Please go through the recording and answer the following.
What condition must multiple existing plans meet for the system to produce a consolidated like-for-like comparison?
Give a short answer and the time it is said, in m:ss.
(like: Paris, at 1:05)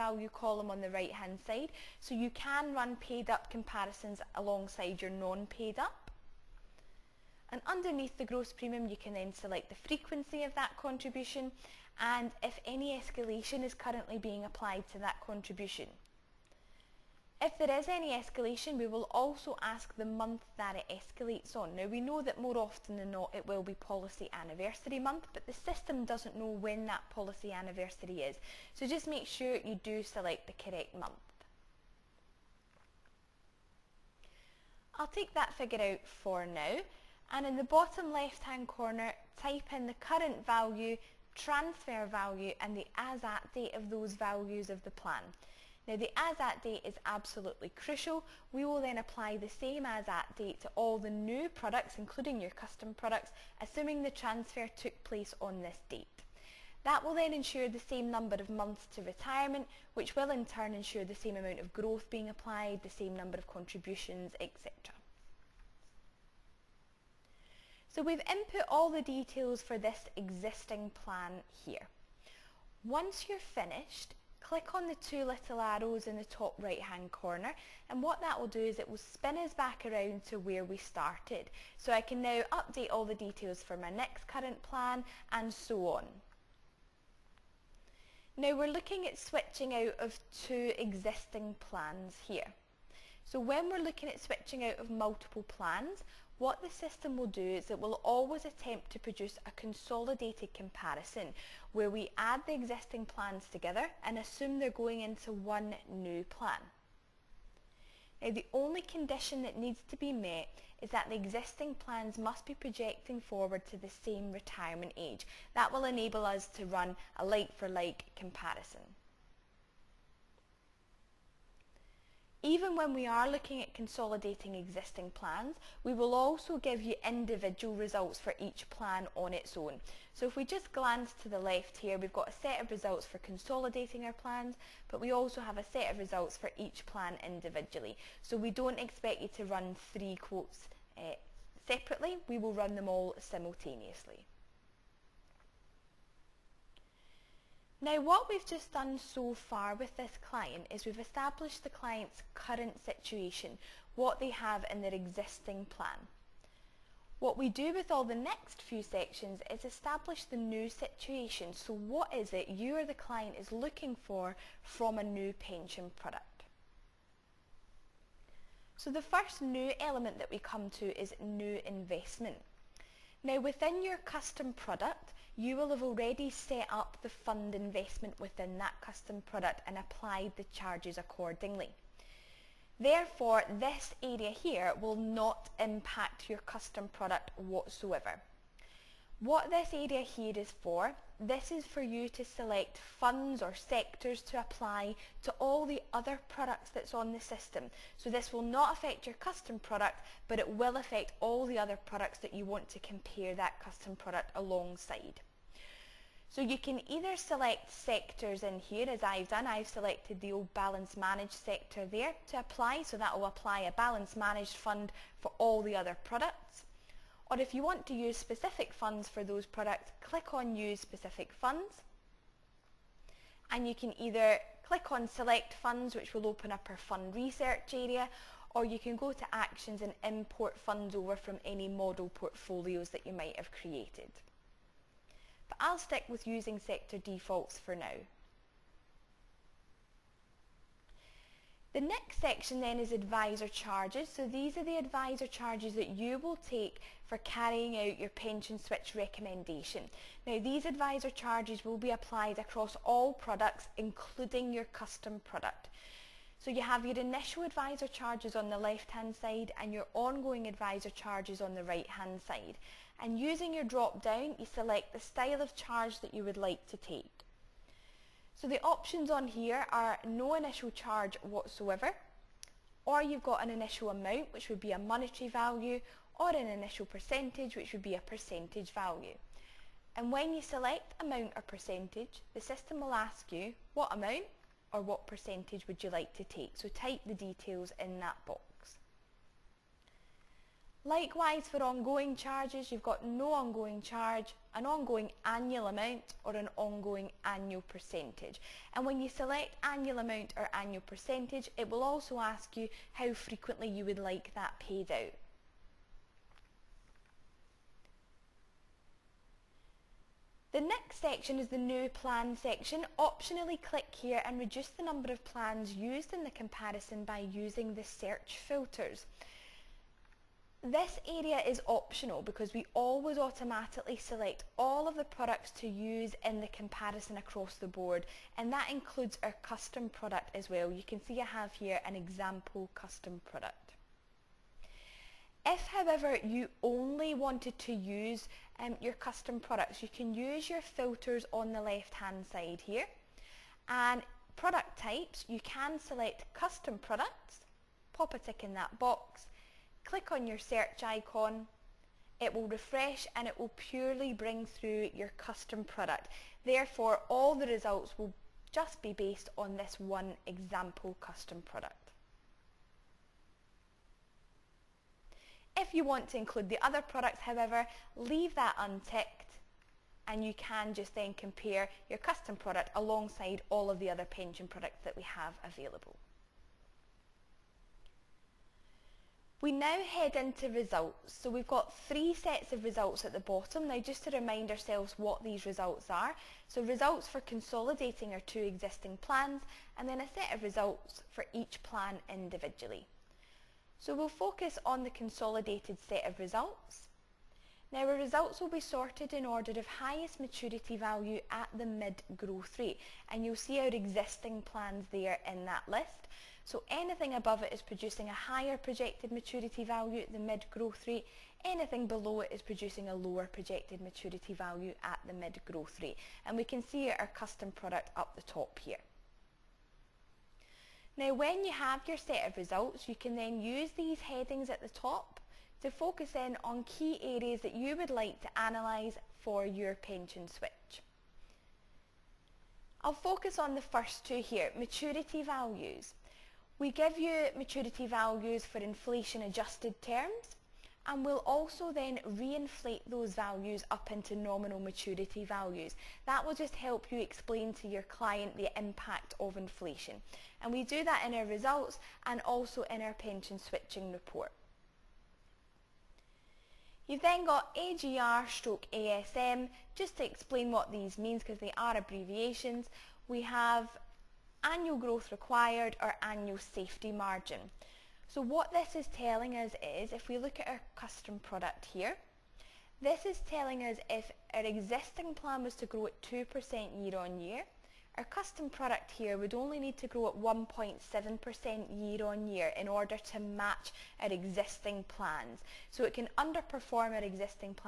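Same retirement age, at 1:54.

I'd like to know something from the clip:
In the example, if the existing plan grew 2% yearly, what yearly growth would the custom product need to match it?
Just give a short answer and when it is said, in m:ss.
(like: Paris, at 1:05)
1.7%, at 8:00.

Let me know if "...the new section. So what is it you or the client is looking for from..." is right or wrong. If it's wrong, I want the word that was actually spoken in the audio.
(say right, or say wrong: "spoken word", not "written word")
wrong: "situation", not "section".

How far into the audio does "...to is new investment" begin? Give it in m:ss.
2:50.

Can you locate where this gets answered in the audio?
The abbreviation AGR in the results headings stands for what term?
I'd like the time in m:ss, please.
7:44.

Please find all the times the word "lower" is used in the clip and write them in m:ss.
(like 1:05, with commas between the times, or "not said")
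6:52.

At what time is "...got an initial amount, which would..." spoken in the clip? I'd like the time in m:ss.
4:33.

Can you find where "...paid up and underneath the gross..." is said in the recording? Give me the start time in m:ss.
0:05.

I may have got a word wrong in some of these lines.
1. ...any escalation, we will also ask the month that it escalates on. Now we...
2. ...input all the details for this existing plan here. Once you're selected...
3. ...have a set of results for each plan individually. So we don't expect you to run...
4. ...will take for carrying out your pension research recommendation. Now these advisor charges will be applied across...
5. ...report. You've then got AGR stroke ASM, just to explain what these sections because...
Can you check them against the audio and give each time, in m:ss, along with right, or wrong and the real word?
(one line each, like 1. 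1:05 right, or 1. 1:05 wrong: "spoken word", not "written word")
1. 0:17 right
2. 1:08 wrong: "finished", not "selected"
3. 2:15 right
4. 4:06 wrong: "switch", not "research"
5. 7:33 wrong: "means", not "sections".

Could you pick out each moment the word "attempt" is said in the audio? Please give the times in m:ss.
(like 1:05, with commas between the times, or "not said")
1:38.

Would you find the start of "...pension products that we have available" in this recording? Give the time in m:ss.
6:14.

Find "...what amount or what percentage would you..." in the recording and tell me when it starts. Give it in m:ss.
4:43.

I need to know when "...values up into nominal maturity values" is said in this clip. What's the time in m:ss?
7:23.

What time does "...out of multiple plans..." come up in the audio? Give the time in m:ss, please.
1:34.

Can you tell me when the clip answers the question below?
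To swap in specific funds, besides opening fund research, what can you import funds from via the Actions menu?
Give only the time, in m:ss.
3:51.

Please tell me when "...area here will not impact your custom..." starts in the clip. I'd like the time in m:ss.
3:04.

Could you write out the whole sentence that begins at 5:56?
Therefore, all the results will just be based on this one example custom product.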